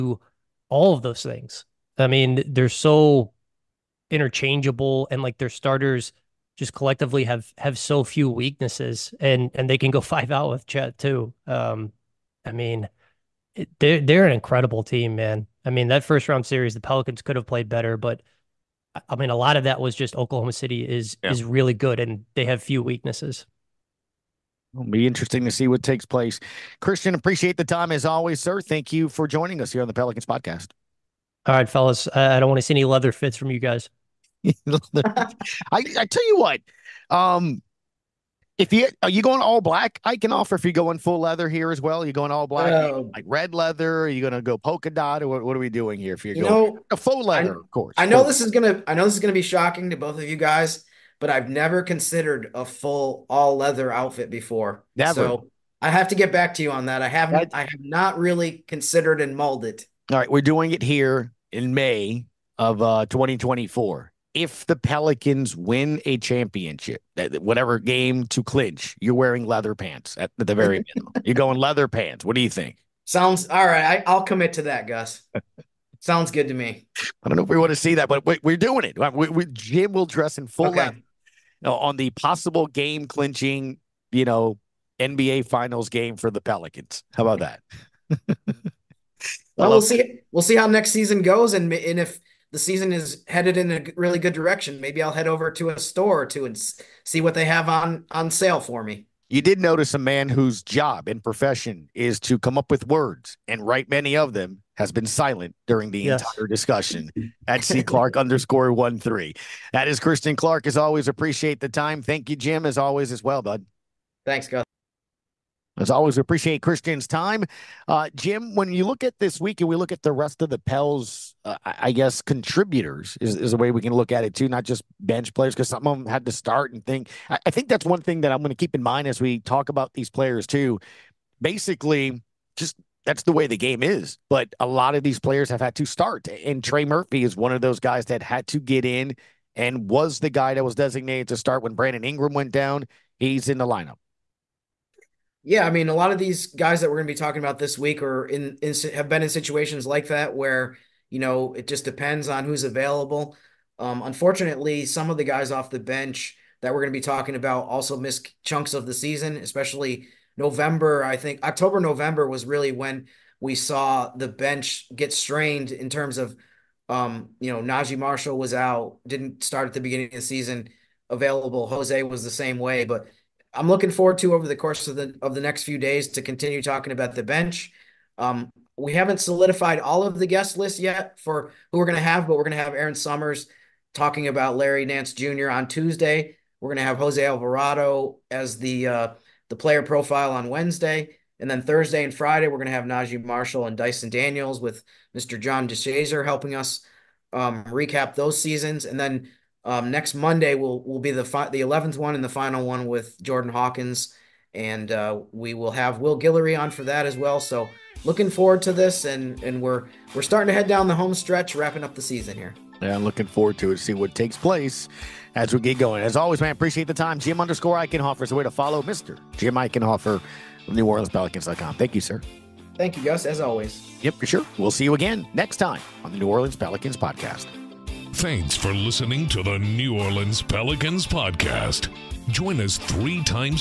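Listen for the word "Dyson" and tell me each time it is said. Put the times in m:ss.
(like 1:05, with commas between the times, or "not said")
3:13.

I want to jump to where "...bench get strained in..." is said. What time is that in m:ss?
2:44.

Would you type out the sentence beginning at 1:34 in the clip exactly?
Maybe I'll head over to a store or two and see what they have on on sale for me.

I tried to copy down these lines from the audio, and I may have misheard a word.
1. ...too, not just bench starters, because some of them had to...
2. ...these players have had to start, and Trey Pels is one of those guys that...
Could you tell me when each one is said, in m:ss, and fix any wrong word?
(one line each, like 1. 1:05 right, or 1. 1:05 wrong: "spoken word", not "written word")
1. 2:04 wrong: "players", not "starters"
2. 2:15 wrong: "Murphy", not "Pels".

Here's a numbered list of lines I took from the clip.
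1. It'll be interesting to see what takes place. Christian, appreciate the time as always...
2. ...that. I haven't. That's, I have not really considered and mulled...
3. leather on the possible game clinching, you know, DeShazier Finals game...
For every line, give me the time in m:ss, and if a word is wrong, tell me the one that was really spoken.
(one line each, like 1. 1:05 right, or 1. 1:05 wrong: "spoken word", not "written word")
1. 0:24 right
2. 0:56 right
3. 1:20 wrong: "NBA", not "DeShazier".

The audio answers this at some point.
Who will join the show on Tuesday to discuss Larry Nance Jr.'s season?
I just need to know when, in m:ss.
3:02.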